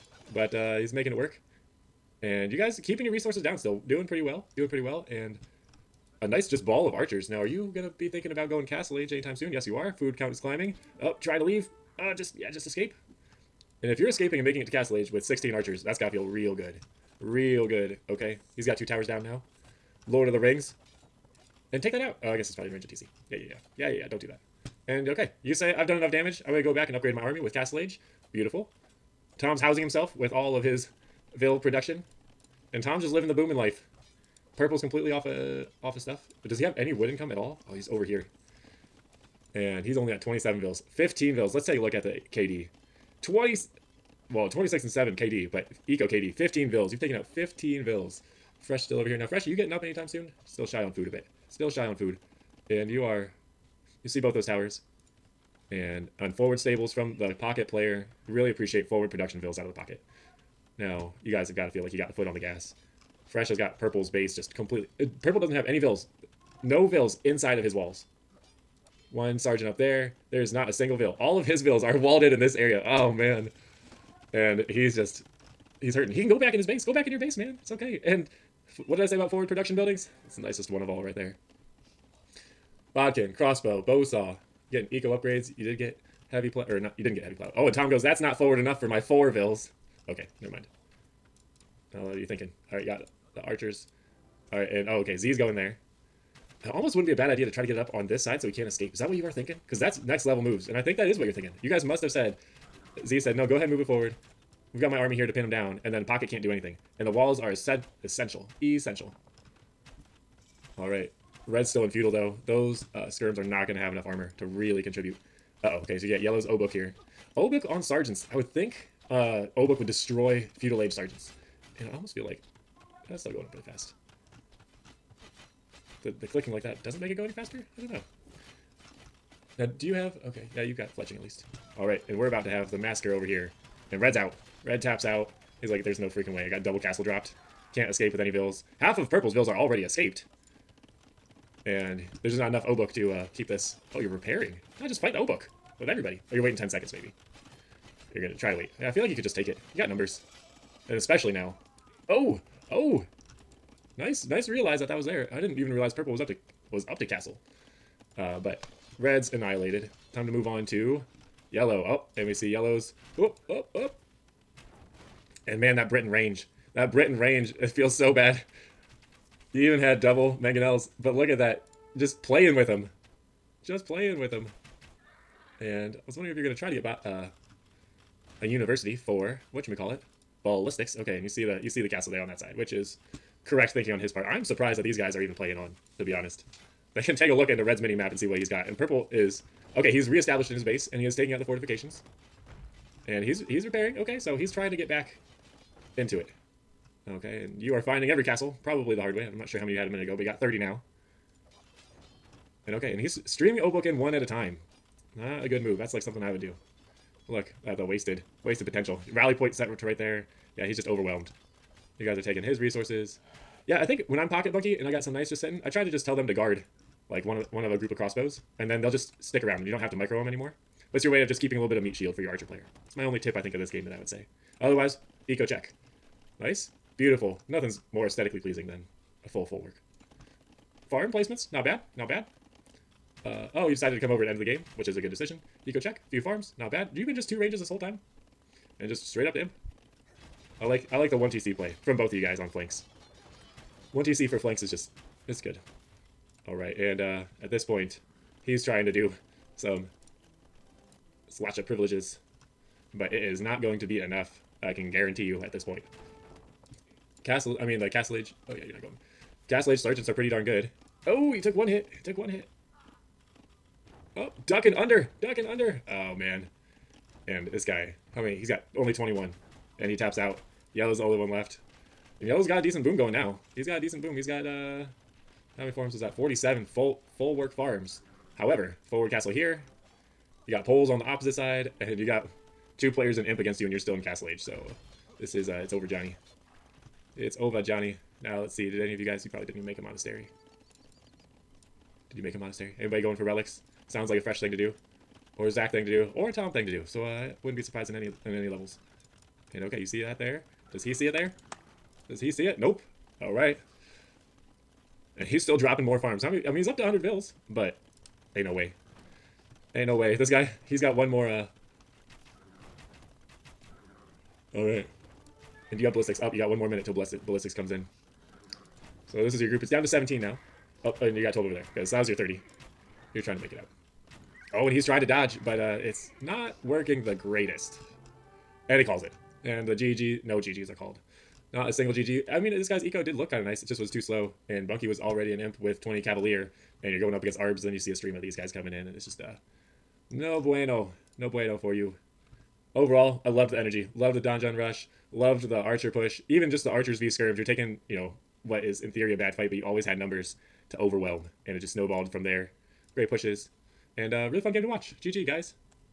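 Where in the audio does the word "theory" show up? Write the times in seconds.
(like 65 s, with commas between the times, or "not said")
348 s.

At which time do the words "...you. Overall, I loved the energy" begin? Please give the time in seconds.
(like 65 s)
341 s.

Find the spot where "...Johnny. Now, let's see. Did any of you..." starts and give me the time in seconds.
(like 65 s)
287 s.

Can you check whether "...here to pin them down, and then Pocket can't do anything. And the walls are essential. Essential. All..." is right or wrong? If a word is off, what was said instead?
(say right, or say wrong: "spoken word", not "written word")
right.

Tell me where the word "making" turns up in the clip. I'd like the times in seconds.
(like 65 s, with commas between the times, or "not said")
0 s, 14 s.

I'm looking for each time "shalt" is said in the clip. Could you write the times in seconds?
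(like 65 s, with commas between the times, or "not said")
not said.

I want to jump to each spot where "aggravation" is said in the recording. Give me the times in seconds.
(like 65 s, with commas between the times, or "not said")
not said.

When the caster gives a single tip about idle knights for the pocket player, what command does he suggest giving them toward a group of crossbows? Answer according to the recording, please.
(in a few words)
Guard.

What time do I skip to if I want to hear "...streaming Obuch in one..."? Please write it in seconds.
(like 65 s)
203 s.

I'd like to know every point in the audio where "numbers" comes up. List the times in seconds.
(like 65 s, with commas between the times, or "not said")
149 s, 349 s.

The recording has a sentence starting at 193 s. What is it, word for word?
Okay, so he's trying to get back into it.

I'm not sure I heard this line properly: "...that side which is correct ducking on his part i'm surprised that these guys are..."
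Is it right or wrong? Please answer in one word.
wrong.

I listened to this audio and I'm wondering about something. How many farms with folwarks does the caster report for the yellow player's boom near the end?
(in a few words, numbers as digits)
47.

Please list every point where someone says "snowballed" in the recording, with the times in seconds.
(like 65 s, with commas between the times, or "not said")
351 s.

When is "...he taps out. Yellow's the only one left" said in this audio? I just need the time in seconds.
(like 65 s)
269 s.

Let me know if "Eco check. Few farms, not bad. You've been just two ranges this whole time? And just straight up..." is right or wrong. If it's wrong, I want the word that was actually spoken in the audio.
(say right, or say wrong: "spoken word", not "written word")
right.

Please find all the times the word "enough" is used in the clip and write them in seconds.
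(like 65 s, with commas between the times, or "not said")
25 s, 88 s, 113 s, 142 s, 253 s.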